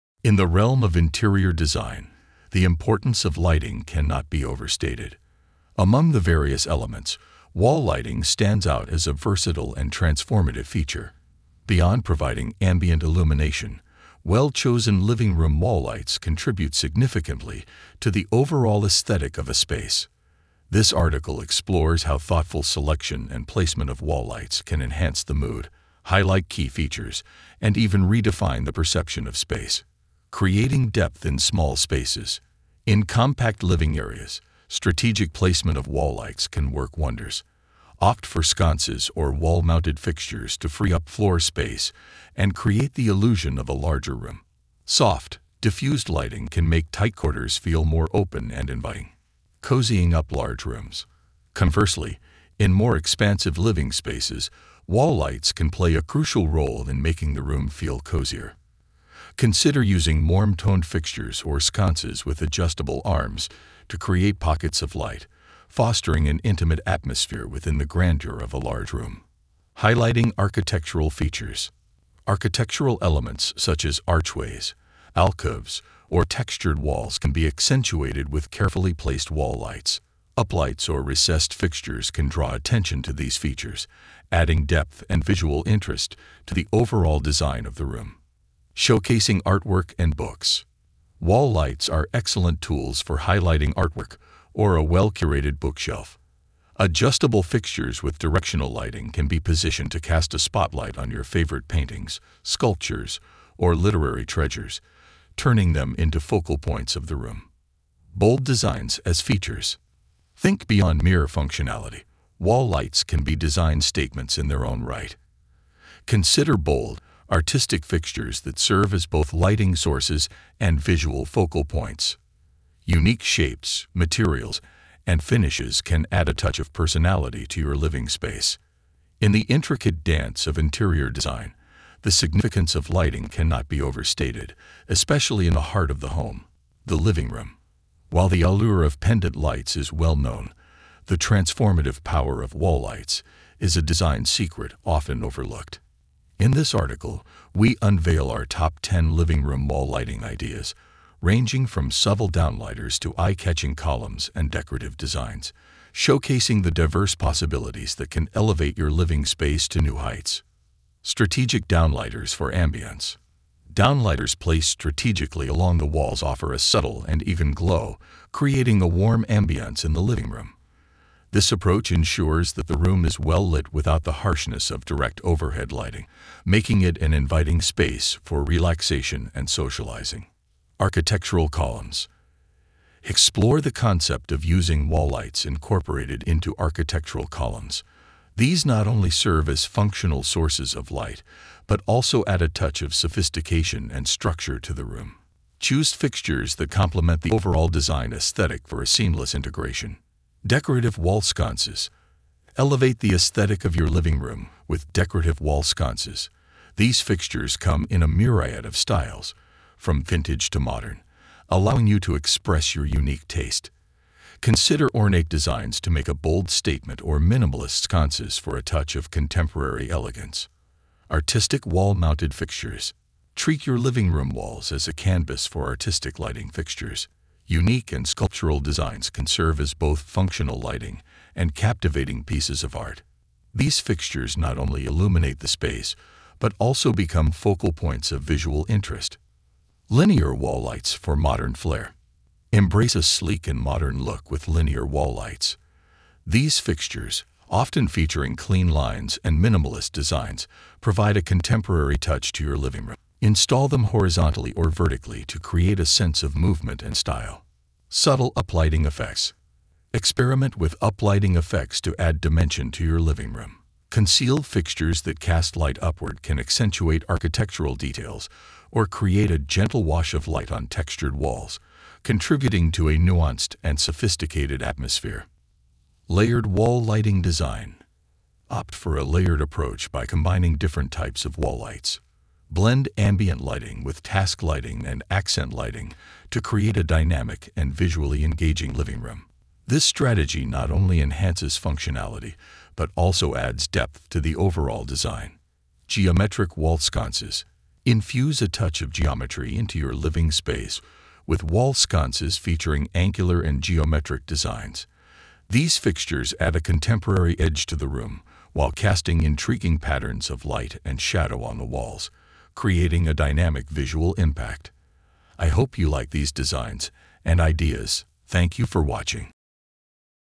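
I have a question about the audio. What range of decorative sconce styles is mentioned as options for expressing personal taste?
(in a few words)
Vintage to modern.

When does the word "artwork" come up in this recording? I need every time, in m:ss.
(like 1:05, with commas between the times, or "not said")
1:29, 1:33.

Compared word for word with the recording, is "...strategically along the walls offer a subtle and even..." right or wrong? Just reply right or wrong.
right.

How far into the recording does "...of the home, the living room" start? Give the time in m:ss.
2:15.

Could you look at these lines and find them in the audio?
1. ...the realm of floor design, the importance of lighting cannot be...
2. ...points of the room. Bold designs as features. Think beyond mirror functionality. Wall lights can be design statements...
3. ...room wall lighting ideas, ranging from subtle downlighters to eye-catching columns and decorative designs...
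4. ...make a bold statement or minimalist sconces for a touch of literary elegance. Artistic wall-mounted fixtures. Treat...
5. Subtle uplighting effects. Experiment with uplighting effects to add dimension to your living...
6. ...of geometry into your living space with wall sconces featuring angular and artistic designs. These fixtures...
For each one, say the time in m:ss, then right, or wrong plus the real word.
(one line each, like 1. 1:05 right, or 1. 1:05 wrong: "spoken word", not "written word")
1. 0:00 wrong: "interior", not "floor"
2. 1:46 right
3. 2:29 right
4. 3:35 wrong: "contemporary", not "literary"
5. 4:17 right
6. 4:58 wrong: "geometric", not "artistic".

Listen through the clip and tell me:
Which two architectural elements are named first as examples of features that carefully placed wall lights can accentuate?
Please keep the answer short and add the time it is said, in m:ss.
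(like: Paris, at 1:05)
Archways, alcoves, at 1:14.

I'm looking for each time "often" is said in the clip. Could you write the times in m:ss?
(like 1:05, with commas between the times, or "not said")
2:24, 4:07.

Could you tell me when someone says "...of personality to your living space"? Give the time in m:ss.
2:06.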